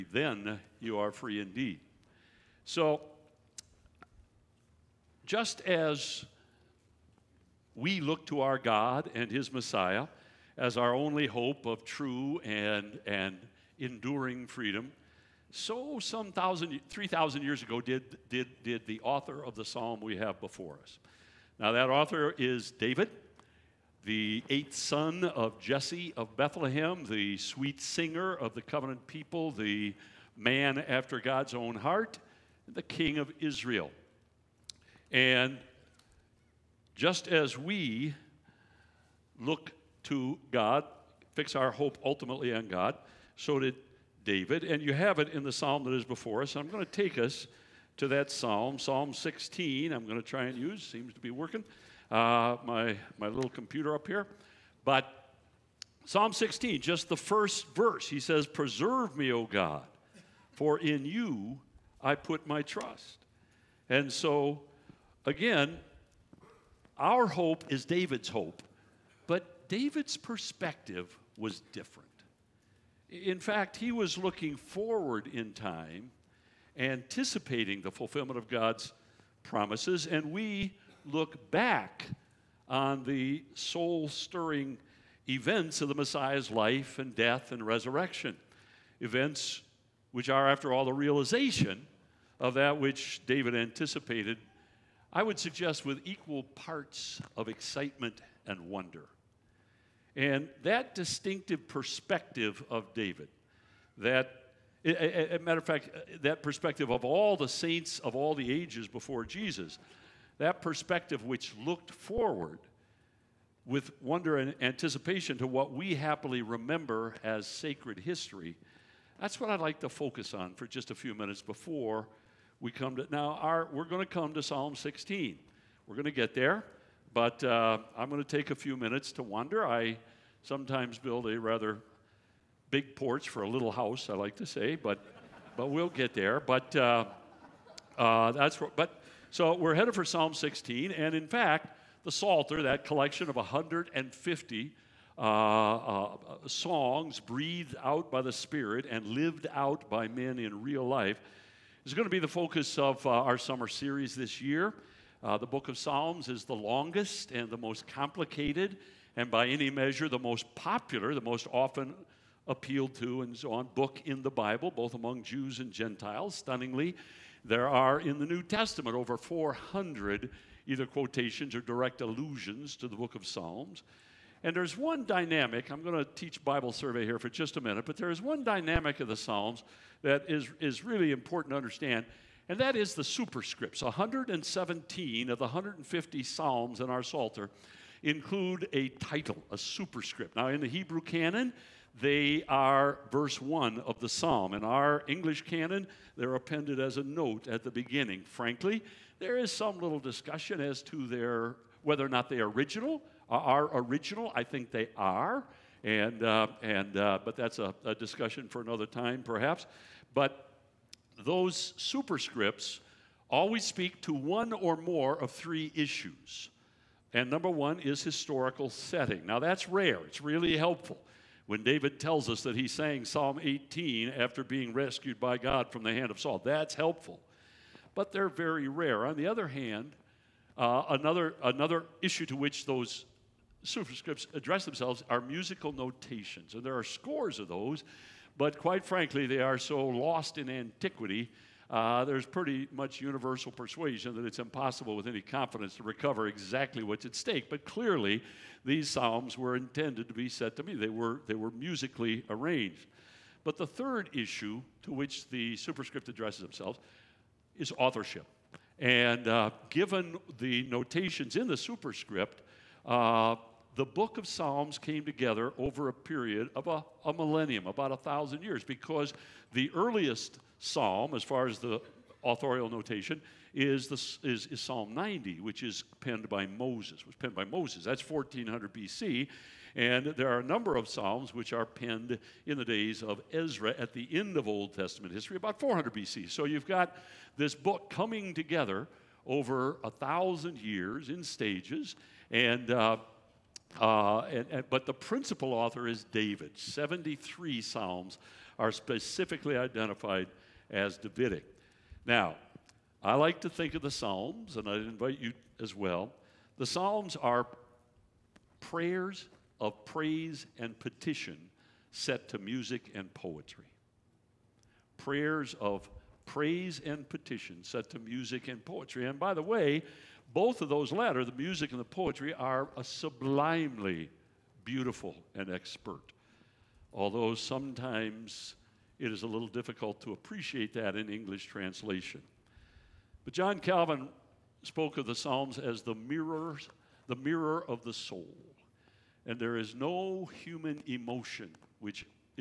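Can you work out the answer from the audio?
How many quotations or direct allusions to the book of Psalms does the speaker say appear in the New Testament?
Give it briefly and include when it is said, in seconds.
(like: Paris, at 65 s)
over 400, at 168 s.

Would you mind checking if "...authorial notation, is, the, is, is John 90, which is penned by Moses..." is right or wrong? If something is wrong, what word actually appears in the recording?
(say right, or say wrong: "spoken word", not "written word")
wrong: "Psalm", not "John".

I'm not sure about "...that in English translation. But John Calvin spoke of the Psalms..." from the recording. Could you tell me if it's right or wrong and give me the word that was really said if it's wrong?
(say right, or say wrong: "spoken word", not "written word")
right.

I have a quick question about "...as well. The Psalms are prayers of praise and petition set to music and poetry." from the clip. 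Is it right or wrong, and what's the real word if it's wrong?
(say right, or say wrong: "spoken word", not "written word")
right.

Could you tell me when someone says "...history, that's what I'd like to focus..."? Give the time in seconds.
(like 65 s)
117 s.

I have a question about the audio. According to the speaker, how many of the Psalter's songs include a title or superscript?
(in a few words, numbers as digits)
117.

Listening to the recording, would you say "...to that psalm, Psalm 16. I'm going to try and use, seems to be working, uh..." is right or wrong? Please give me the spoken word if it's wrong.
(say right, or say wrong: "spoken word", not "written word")
right.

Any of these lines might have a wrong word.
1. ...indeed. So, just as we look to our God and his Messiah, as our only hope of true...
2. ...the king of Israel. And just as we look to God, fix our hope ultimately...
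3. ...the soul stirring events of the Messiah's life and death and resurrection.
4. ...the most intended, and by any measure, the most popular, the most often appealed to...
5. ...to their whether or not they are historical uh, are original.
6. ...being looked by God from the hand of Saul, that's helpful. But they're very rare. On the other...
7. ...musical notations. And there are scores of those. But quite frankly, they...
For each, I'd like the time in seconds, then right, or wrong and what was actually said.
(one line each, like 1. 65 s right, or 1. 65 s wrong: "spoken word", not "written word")
1. 1 s right
2. 32 s right
3. 83 s right
4. 157 s wrong: "complicated", not "intended"
5. 200 s wrong: "original", not "historical"
6. 224 s wrong: "rescued", not "looked"
7. 235 s right.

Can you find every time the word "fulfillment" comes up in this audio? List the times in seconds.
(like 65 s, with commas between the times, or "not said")
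77 s.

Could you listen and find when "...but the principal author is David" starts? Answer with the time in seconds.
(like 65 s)
294 s.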